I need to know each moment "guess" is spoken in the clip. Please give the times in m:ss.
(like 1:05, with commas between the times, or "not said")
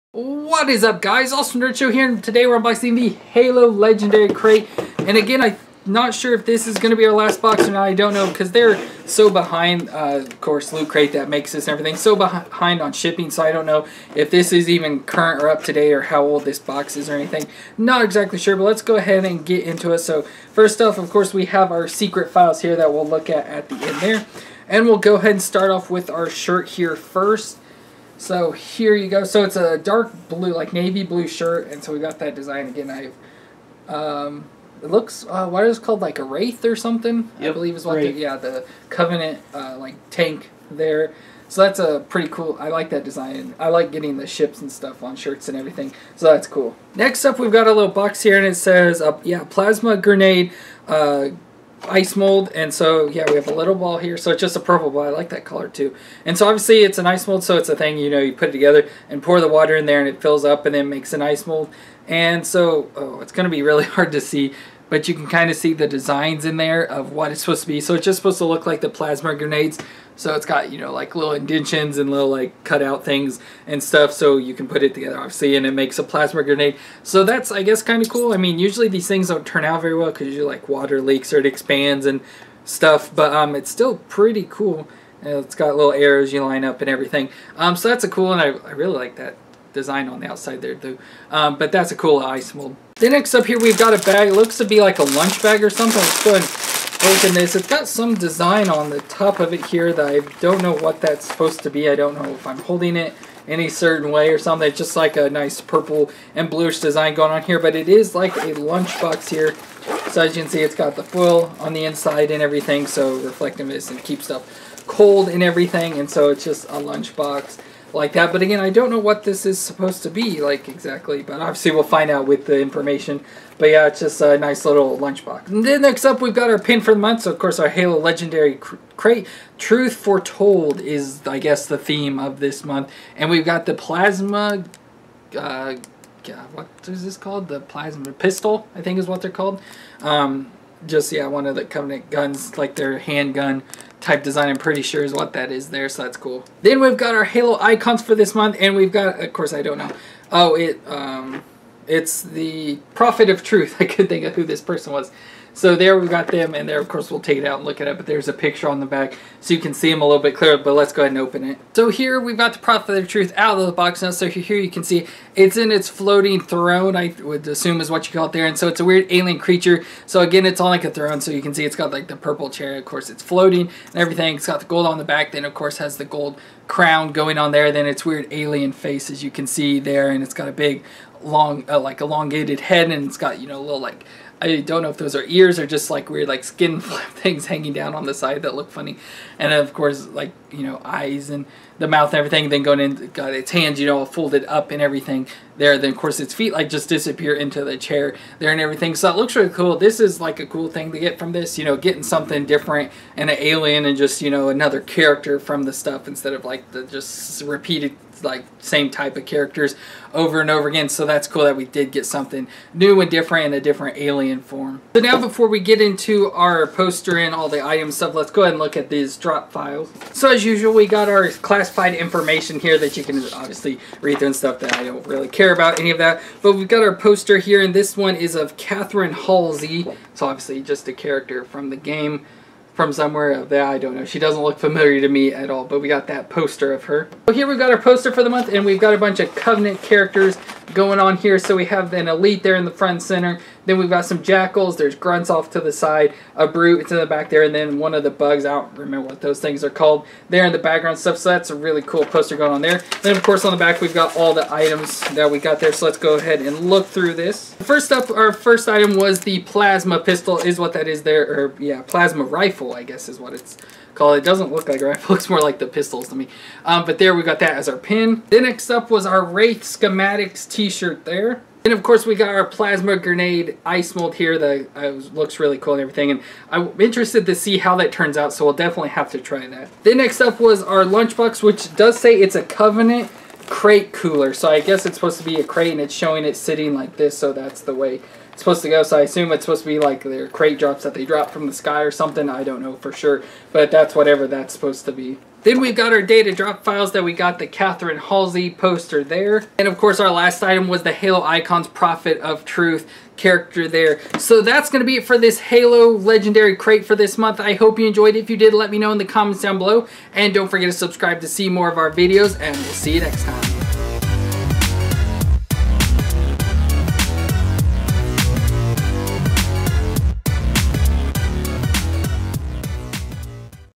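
1:17, 2:11, 4:22, 4:44.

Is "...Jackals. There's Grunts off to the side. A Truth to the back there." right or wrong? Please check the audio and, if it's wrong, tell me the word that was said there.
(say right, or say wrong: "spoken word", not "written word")
wrong: "Brute", not "Truth".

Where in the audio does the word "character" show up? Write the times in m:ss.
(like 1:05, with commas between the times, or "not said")
3:24, 3:29, 3:50, 3:59, 5:03.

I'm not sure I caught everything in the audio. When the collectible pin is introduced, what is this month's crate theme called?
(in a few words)
Truth Foretold.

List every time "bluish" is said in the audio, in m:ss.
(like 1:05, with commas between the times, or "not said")
1:46.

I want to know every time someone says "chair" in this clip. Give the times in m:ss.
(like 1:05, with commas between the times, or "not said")
2:52, 3:17.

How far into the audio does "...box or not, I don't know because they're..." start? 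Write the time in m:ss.
0:07.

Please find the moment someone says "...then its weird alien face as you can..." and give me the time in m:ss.
2:57.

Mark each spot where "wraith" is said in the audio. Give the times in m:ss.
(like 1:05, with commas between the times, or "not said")
0:36, 4:29.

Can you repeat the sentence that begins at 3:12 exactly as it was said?
Then going in got its hands you know folded up and everything there.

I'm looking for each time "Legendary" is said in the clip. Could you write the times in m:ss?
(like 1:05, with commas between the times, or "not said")
0:03, 2:07, 5:05.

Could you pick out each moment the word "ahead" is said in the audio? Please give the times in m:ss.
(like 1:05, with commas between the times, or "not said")
0:18, 0:25, 1:36, 2:41, 3:38, 4:16.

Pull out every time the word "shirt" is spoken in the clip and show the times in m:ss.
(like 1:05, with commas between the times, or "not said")
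0:26, 0:31, 0:45, 4:30.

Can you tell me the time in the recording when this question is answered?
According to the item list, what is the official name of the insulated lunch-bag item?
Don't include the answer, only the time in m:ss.
4:42.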